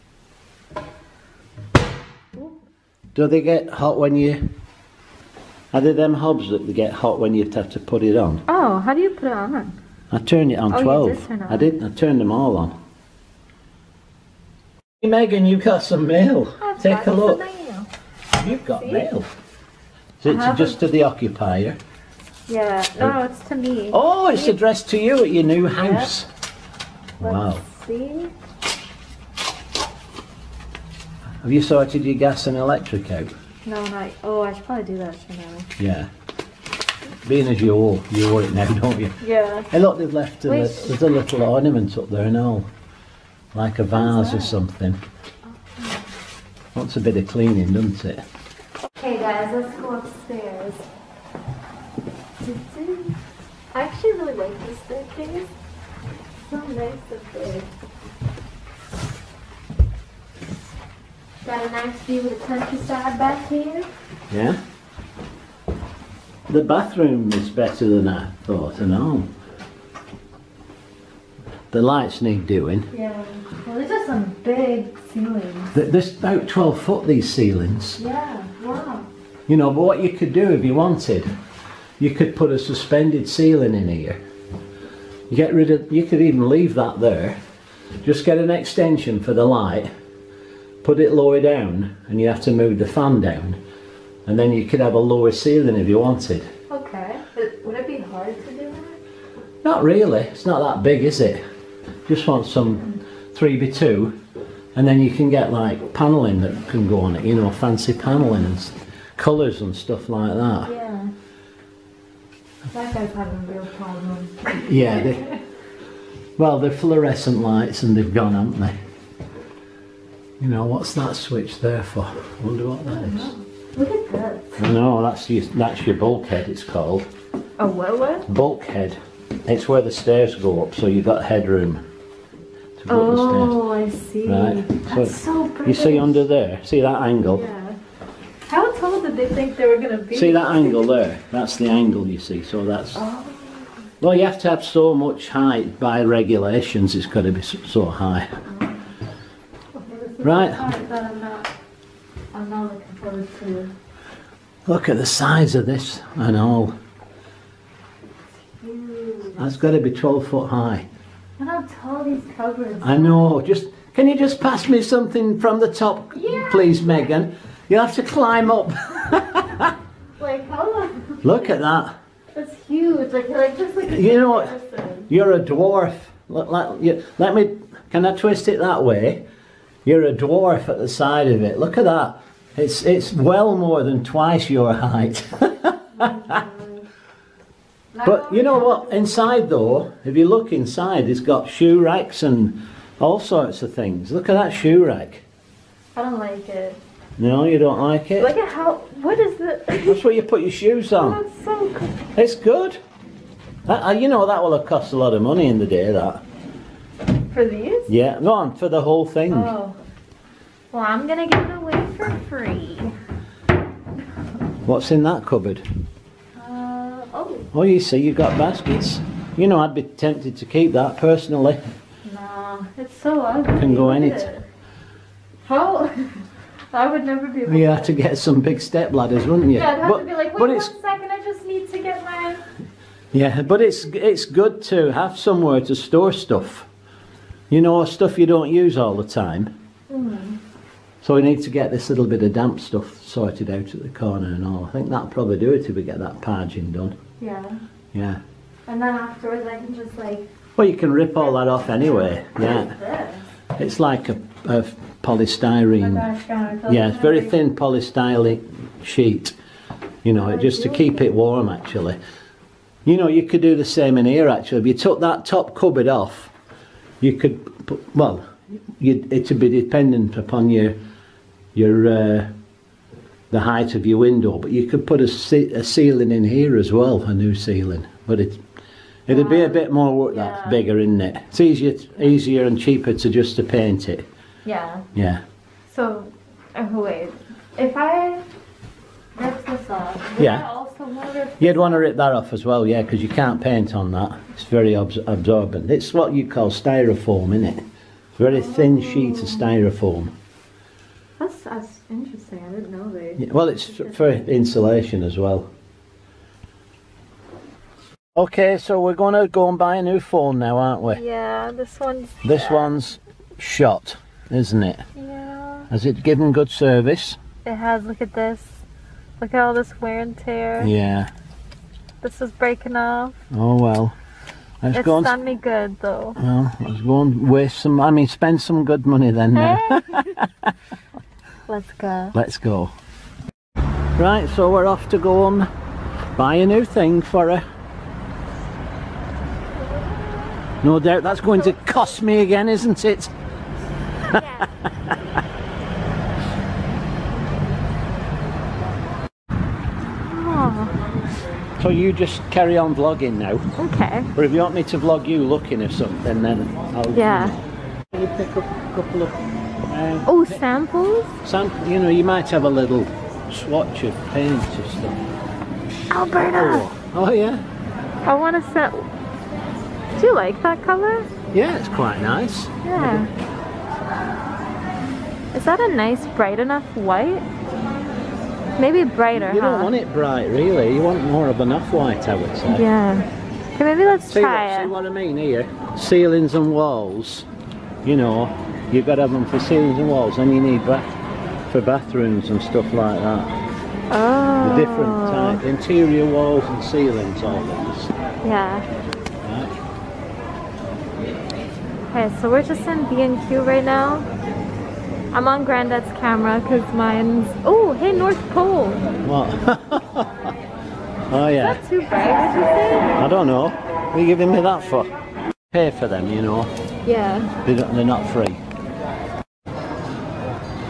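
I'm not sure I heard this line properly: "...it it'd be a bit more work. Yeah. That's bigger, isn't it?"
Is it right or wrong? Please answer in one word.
right.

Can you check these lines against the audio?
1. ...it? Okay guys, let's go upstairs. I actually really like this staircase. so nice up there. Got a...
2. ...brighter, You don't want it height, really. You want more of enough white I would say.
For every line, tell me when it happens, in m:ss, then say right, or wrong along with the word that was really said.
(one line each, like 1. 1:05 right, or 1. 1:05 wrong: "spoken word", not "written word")
1. 0:48 right
2. 6:18 wrong: "bright", not "height".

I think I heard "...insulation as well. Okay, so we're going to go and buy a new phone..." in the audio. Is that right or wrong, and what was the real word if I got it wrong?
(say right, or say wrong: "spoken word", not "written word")
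right.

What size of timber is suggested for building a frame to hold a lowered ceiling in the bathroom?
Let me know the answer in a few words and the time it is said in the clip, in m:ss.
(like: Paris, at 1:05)
3x2, at 1:43.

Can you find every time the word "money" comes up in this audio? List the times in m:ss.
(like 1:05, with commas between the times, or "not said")
3:25, 5:28.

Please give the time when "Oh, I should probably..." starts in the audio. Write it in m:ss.
0:34.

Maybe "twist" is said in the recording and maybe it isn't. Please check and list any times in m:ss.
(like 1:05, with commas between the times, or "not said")
2:58.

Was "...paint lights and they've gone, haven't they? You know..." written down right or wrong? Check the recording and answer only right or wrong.
wrong.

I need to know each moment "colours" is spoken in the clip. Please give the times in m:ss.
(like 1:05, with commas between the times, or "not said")
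1:49, 6:10.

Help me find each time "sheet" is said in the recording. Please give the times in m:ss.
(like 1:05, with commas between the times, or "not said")
4:18, 4:58.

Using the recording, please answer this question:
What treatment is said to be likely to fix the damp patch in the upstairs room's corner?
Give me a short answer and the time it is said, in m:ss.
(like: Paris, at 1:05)
Parging, at 4:06.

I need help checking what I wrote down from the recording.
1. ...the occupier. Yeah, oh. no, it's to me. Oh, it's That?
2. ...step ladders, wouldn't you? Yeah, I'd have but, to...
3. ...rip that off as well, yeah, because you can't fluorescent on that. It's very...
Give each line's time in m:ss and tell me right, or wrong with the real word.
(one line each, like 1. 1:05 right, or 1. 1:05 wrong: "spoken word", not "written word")
1. 0:20 wrong: "See", not "That"
2. 3:48 right
3. 4:51 wrong: "paint", not "fluorescent".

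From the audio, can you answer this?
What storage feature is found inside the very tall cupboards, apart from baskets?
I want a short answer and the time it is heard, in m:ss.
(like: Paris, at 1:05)
Shoe racks, at 3:11.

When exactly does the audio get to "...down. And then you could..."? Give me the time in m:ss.
1:33.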